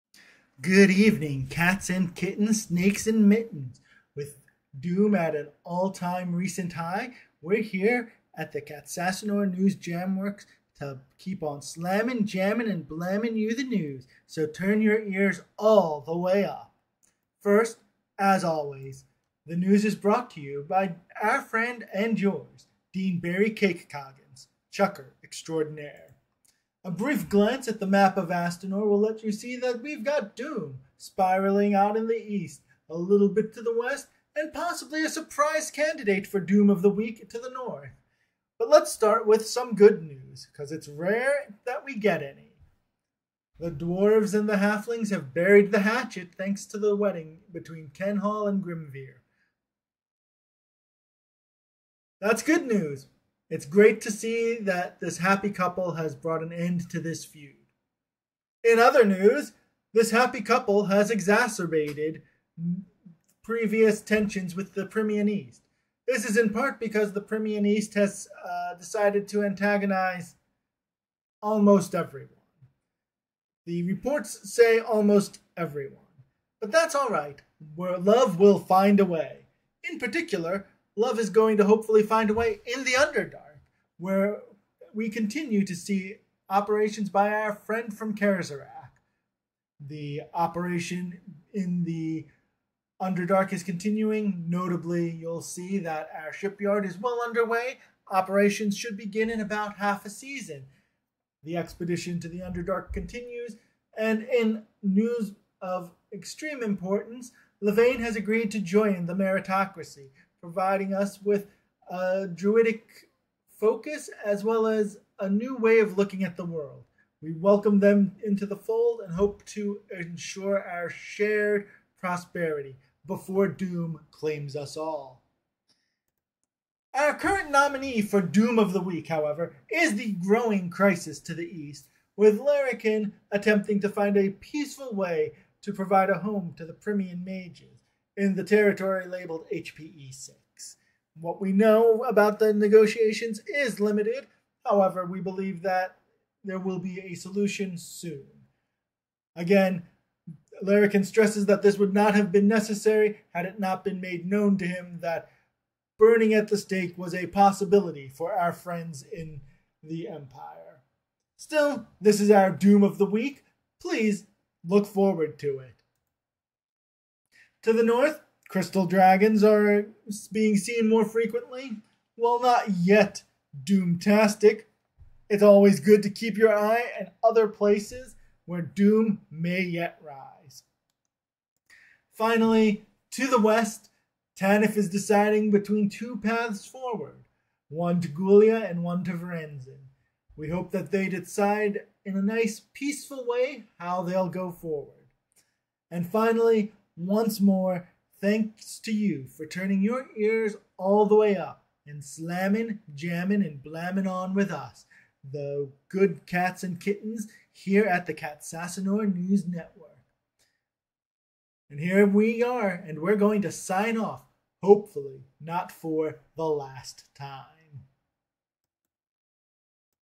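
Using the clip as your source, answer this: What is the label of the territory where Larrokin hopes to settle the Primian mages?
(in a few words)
HPE 6.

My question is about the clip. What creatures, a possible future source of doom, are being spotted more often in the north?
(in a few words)
crystal dragons.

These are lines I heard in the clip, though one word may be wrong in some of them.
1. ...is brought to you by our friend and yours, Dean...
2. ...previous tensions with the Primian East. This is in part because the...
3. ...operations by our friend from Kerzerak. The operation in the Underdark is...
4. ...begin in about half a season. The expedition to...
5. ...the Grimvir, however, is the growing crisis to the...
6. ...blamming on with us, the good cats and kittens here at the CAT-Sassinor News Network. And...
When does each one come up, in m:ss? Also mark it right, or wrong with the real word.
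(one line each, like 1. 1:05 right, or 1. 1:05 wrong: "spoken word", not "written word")
1. 0:19 right
2. 1:03 right
3. 1:26 right
4. 1:38 right
5. 2:08 wrong: "Week", not "Grimvir"
6. 3:23 right.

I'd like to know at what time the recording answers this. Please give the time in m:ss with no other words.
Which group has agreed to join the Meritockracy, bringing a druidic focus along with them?
1:47.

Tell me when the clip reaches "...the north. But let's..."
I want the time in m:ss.
0:37.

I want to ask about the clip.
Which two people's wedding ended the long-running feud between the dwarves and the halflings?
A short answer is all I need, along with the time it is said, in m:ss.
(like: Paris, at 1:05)
Kenhall and Grimvir, at 0:47.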